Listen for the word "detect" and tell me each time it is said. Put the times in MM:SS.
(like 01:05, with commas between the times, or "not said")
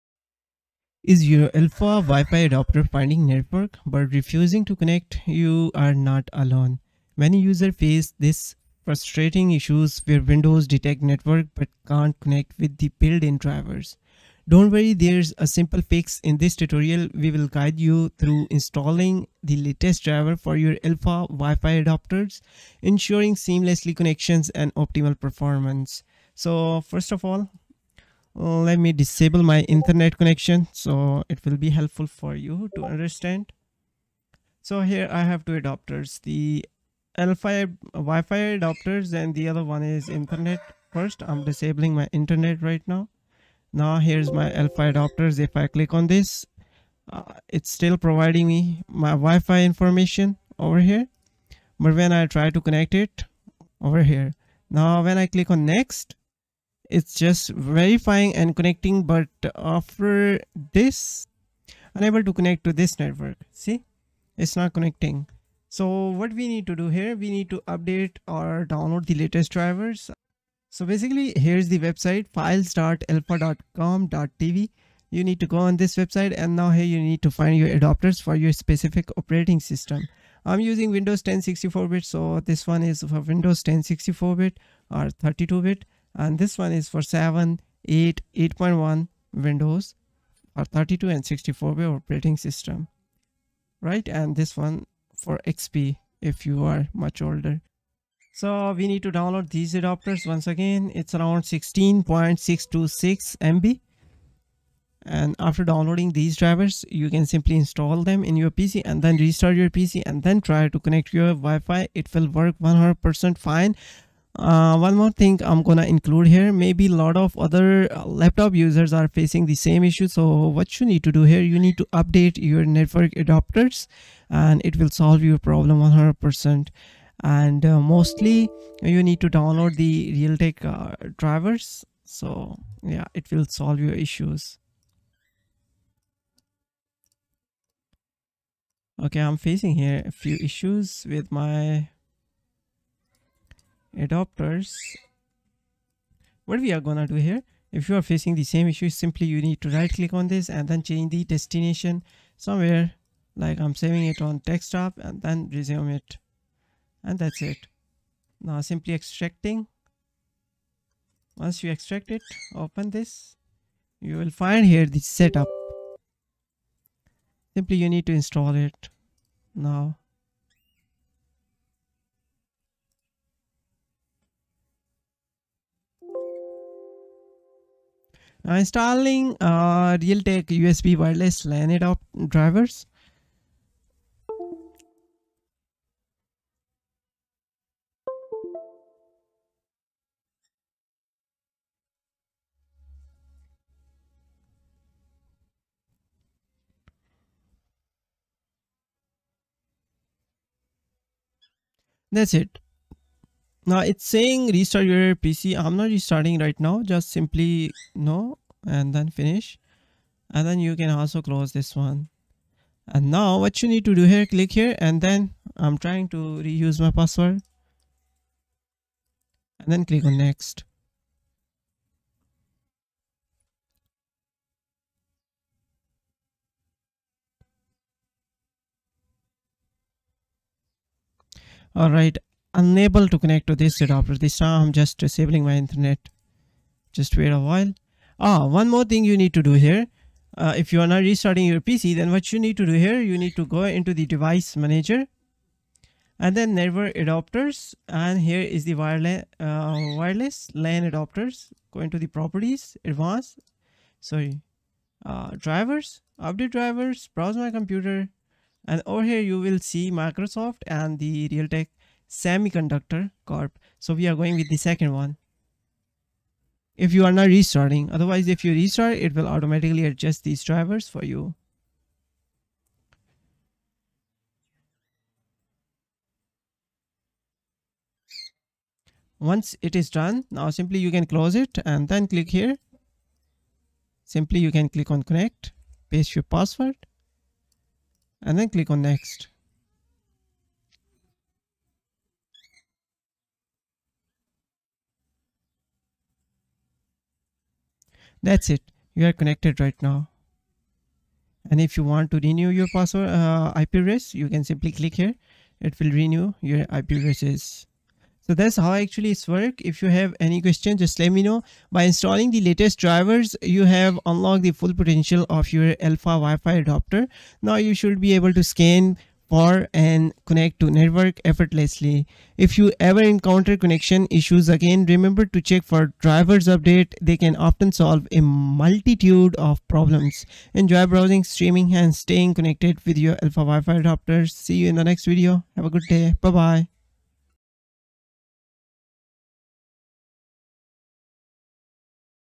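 00:10.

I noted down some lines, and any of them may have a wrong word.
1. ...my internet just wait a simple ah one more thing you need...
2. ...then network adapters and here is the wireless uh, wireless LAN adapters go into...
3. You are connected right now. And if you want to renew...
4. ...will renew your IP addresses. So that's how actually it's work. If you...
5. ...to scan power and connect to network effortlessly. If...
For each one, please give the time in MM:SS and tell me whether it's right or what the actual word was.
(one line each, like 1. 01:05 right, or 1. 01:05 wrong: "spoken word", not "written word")
1. 03:55 wrong: "while", not "simple"
2. 04:06 right
3. 04:58 right
4. 05:05 right
5. 05:18 right.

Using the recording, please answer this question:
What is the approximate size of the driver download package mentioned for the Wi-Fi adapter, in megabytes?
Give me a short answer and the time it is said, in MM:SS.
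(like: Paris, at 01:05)
16.626 MB, at 01:41.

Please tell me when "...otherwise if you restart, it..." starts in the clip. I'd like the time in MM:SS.
04:27.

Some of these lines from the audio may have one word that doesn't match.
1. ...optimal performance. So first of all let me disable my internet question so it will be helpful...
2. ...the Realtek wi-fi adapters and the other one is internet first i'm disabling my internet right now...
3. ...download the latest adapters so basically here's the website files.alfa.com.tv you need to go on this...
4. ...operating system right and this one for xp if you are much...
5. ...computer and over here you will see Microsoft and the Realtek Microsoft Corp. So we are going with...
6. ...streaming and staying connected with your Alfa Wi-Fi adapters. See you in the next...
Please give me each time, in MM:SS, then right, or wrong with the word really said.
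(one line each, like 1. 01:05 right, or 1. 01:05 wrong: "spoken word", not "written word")
1. 00:24 wrong: "connection", not "question"
2. 00:36 wrong: "Alfa", not "Realtek"
3. 01:08 wrong: "drivers", not "adapters"
4. 01:31 right
5. 04:17 wrong: "Semiconductor", not "Microsoft"
6. 05:31 right.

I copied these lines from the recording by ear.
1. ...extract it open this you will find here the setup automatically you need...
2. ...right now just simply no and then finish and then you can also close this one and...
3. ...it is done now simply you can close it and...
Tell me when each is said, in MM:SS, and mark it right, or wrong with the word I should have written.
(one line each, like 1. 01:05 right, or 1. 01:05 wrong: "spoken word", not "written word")
1. 02:41 wrong: "simply", not "automatically"
2. 03:26 right
3. 04:39 right.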